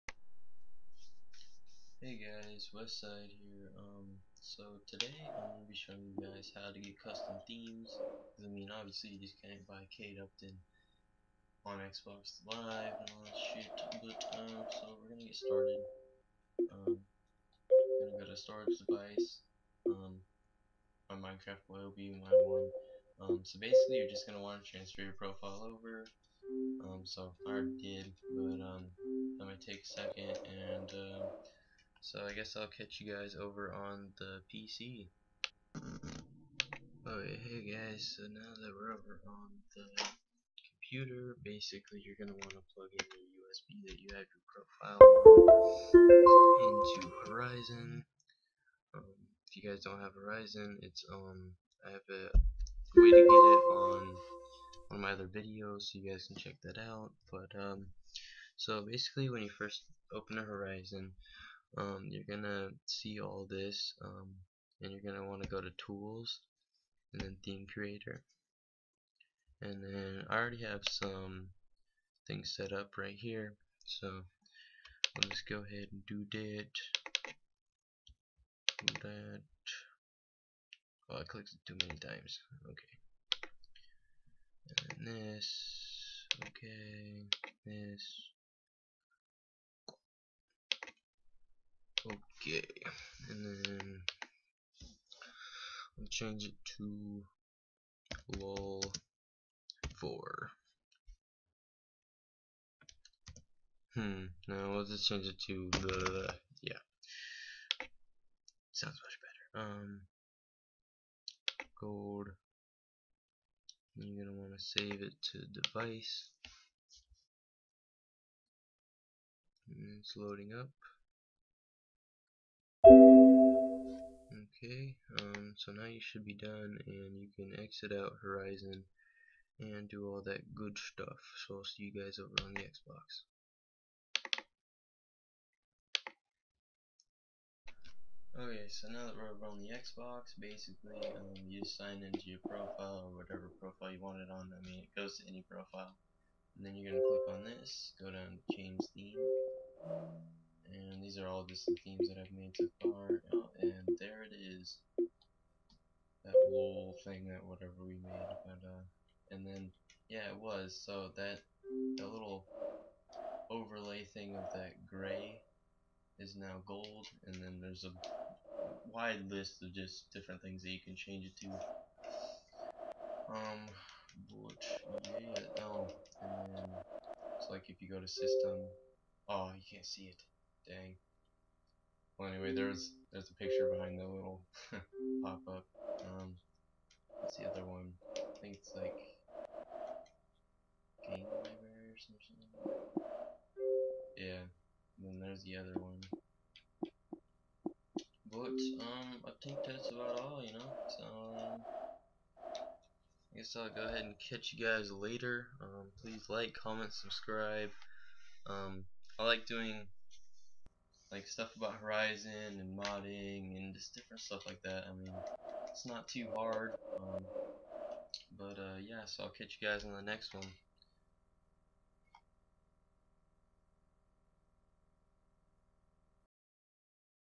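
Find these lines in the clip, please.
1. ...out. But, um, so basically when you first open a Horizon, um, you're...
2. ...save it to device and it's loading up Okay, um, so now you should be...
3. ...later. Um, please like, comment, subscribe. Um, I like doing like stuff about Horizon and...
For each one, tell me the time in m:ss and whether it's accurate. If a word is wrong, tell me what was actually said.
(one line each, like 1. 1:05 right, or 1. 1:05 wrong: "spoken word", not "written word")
1. 0:56 right
2. 1:54 right
3. 3:24 right.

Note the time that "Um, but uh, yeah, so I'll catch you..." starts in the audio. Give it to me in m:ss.
3:36.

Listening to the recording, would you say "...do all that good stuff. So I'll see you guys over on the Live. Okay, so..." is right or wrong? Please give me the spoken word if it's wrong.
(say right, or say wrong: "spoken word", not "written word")
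wrong: "Xbox", not "Live".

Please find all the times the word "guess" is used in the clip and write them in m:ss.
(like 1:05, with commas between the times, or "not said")
0:32, 3:23.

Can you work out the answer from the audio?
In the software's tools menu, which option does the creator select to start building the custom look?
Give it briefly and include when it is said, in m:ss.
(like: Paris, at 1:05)
Theme creator, at 1:07.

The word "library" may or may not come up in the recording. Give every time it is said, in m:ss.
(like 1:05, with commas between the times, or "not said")
3:11.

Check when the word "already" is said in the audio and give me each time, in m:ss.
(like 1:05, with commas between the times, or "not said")
0:27, 1:10.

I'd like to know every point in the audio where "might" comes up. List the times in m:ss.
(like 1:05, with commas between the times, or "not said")
0:29.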